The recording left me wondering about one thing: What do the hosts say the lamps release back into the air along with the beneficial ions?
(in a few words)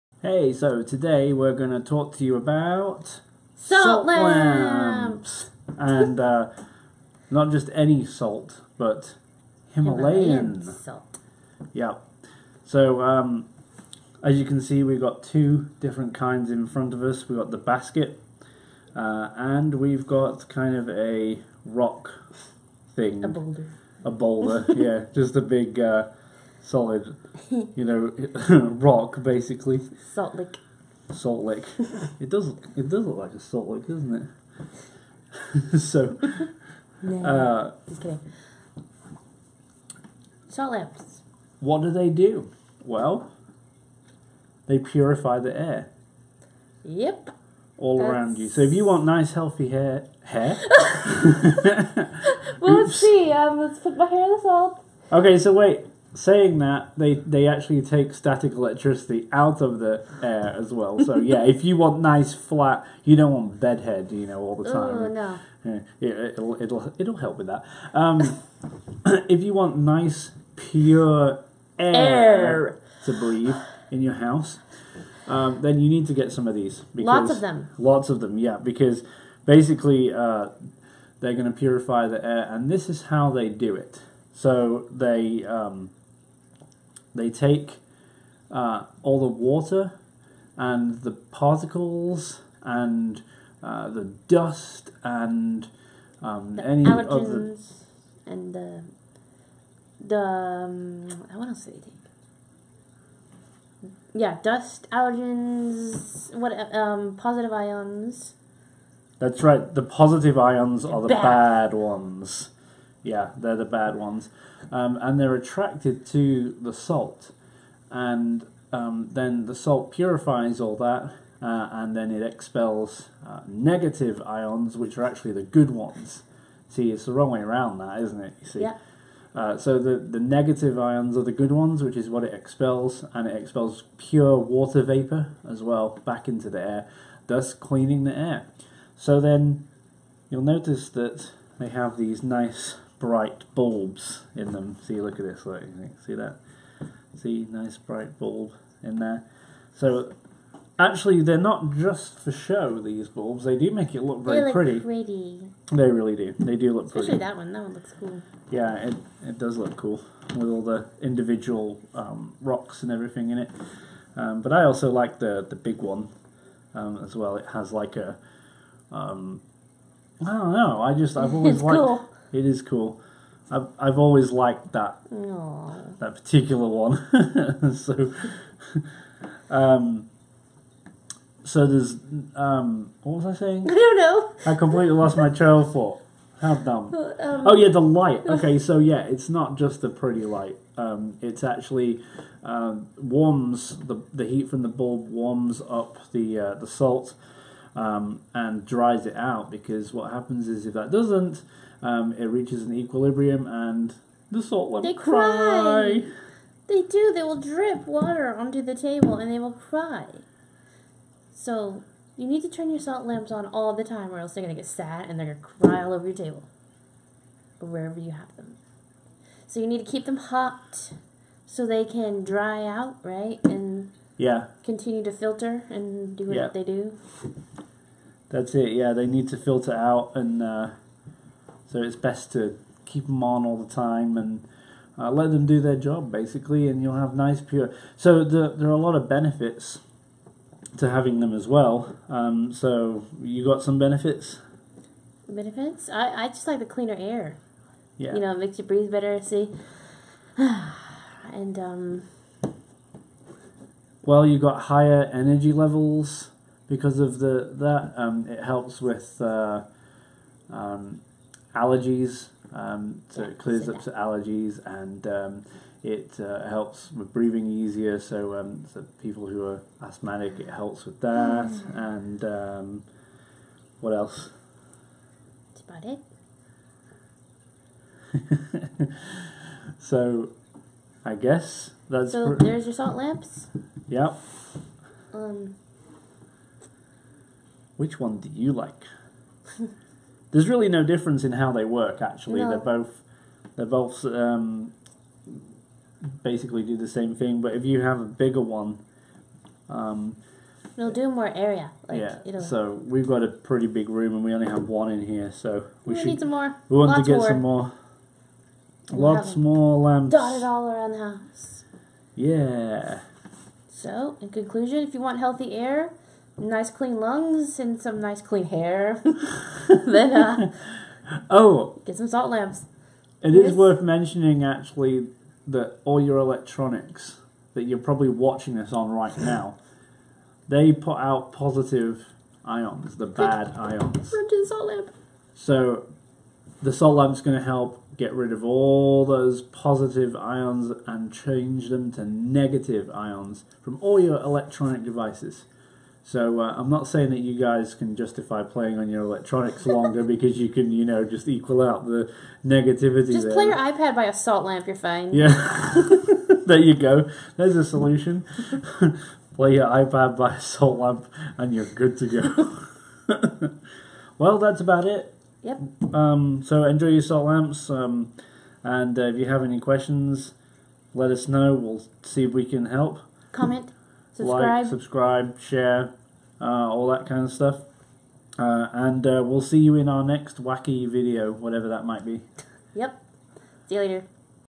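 Pure water vapor.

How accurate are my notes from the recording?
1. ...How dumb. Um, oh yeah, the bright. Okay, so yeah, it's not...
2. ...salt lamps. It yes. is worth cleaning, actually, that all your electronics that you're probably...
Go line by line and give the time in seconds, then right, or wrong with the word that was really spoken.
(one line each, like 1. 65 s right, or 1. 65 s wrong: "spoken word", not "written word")
1. 186 s wrong: "light", not "bright"
2. 322 s wrong: "mentioning", not "cleaning".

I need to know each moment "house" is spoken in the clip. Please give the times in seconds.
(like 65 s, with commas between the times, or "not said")
74 s, 310 s.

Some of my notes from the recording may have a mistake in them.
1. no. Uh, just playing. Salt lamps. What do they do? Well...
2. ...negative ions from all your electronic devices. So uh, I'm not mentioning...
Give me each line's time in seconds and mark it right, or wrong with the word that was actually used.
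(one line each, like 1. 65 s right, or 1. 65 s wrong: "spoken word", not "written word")
1. 37 s wrong: "kidding", not "playing"
2. 342 s wrong: "saying", not "mentioning".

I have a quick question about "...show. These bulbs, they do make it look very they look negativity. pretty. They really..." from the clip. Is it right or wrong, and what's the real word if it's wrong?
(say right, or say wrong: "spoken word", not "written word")
wrong: "pretty", not "negativity".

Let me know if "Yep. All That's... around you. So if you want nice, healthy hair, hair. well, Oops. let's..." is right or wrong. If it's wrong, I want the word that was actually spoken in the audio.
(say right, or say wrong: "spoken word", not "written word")
right.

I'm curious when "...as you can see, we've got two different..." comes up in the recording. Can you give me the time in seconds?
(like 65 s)
14 s.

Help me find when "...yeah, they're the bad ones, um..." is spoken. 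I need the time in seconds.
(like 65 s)
113 s.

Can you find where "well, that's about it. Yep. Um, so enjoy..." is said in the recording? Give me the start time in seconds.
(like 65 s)
364 s.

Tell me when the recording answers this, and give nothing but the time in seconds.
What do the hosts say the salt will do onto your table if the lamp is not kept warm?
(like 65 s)
207 s.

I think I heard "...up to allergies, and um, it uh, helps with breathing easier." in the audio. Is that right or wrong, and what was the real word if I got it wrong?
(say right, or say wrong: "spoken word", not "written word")
right.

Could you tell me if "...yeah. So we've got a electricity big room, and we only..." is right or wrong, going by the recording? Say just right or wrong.
wrong.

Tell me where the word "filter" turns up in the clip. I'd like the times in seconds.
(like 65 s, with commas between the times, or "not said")
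225 s, 229 s.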